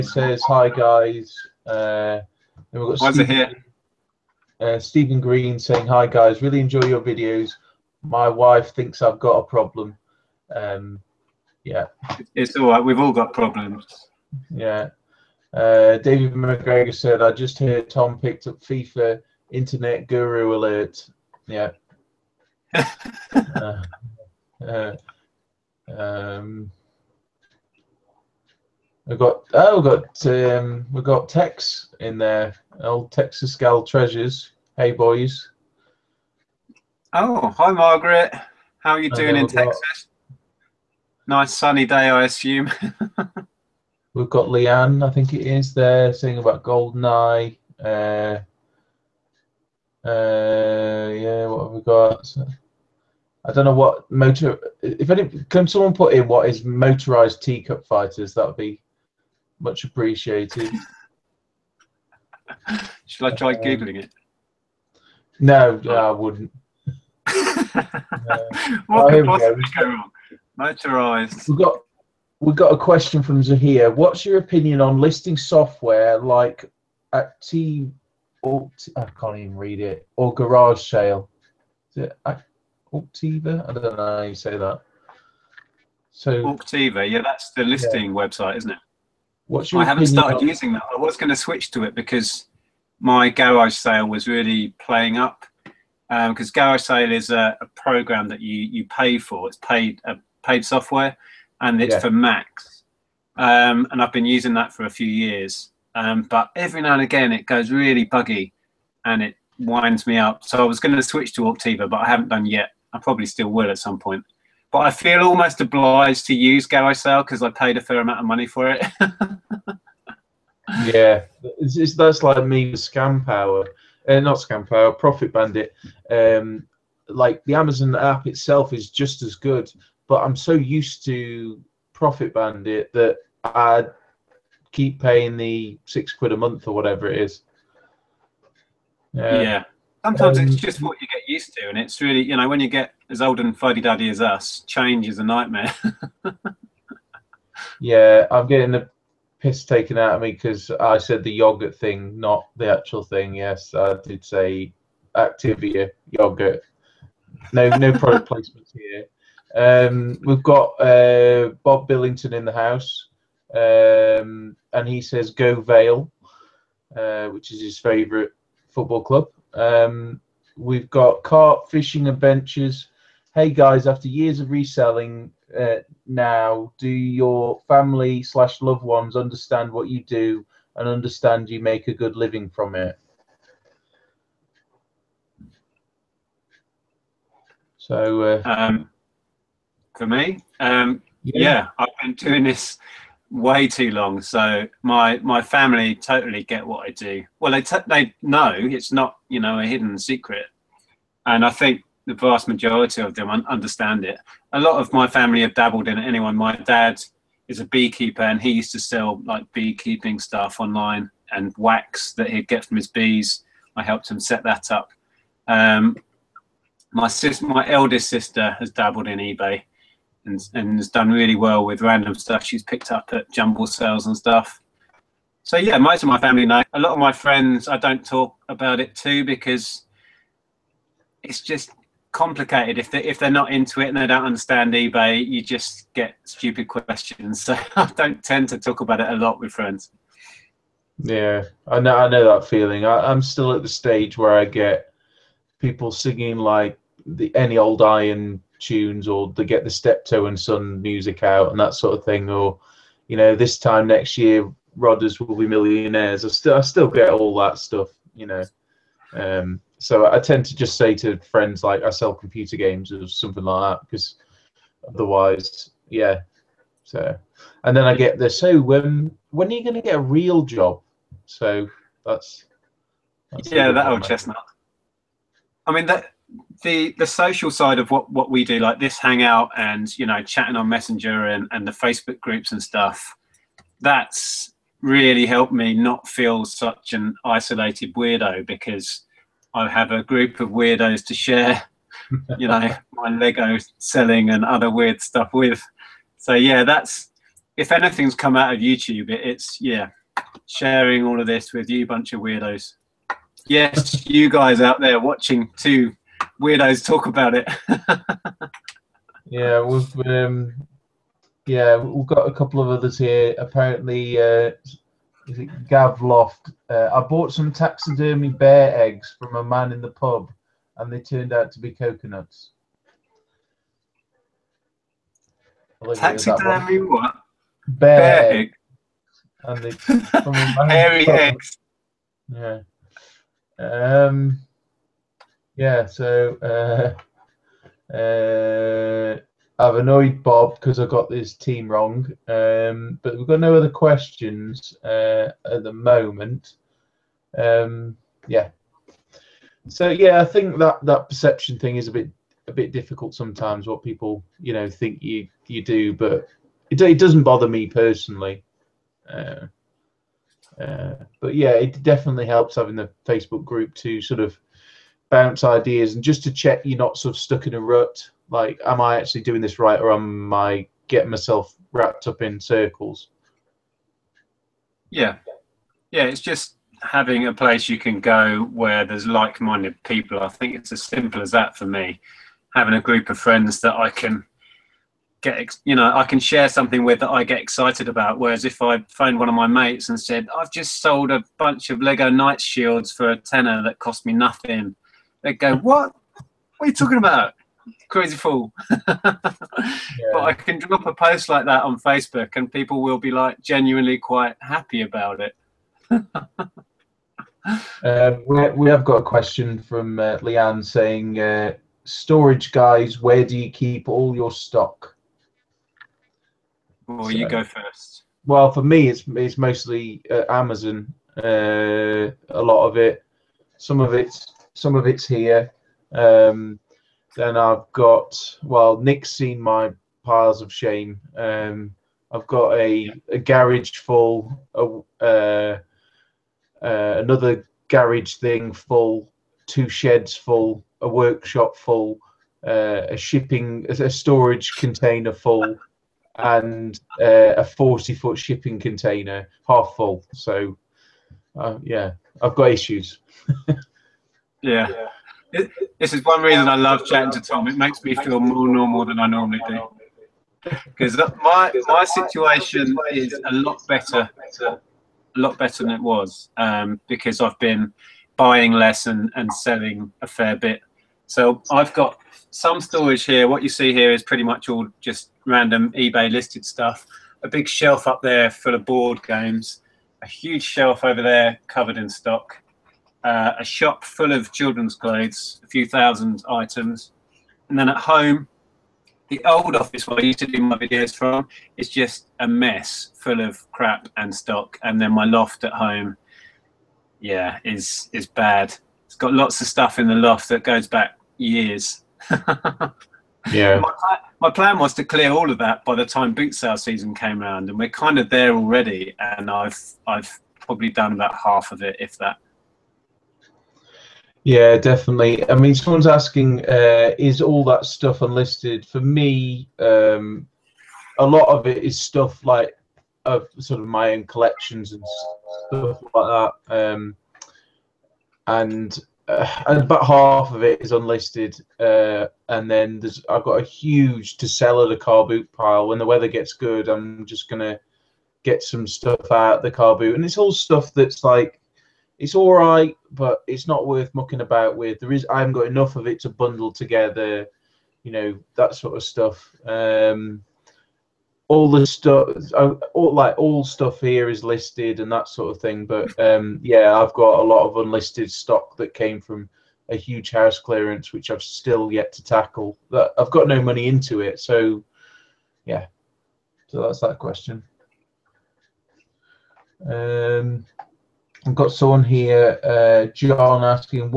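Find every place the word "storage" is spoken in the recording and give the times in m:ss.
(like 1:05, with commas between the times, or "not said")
6:51, 7:23, 7:52.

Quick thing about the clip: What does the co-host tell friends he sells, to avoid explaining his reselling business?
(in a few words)
computer games.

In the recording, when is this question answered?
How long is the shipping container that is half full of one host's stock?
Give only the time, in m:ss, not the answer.
7:27.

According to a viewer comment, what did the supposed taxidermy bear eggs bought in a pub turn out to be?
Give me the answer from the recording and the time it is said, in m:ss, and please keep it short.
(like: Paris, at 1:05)
coconuts, at 5:21.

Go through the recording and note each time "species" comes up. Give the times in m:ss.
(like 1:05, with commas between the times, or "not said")
not said.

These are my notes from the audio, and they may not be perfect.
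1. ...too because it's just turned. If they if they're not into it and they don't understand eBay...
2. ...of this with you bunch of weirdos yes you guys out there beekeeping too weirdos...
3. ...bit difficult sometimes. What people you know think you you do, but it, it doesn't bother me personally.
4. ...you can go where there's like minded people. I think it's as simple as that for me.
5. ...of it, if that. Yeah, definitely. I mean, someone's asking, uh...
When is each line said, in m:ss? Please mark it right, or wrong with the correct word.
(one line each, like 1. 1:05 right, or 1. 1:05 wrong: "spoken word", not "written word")
1. 3:48 wrong: "complicated", not "turned"
2. 5:01 wrong: "watching", not "beekeeping"
3. 5:52 right
4. 6:17 right
5. 8:31 right.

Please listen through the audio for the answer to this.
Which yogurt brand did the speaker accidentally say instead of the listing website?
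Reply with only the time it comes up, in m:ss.
2:35.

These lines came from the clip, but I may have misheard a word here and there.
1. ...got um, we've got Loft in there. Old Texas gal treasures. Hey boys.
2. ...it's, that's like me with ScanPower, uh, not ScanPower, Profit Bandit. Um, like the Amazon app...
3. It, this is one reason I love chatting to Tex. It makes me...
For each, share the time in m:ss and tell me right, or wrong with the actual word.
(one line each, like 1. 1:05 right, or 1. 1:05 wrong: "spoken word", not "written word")
1. 0:29 wrong: "Tex", not "Loft"
2. 2:01 right
3. 7:35 wrong: "Tom", not "Tex".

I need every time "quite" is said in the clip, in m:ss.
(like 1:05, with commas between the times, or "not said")
6:43.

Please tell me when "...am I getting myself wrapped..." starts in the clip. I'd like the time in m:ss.
6:09.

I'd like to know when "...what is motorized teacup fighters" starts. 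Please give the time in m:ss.
0:56.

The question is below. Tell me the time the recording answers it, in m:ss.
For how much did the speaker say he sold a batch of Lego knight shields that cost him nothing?
6:33.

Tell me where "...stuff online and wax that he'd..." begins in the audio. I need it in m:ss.
3:30.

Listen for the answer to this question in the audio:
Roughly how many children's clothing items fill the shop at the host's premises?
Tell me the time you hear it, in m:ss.
8:05.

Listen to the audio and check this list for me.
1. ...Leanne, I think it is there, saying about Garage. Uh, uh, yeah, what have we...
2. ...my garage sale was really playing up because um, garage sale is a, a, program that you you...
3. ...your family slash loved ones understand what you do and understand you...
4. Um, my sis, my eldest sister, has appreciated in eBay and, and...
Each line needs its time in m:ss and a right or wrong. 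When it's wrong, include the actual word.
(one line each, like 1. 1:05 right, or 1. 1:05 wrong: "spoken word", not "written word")
1. 0:44 wrong: "Goldeneye", not "Garage"
2. 1:32 right
3. 2:56 right
4. 3:35 wrong: "dabbled", not "appreciated".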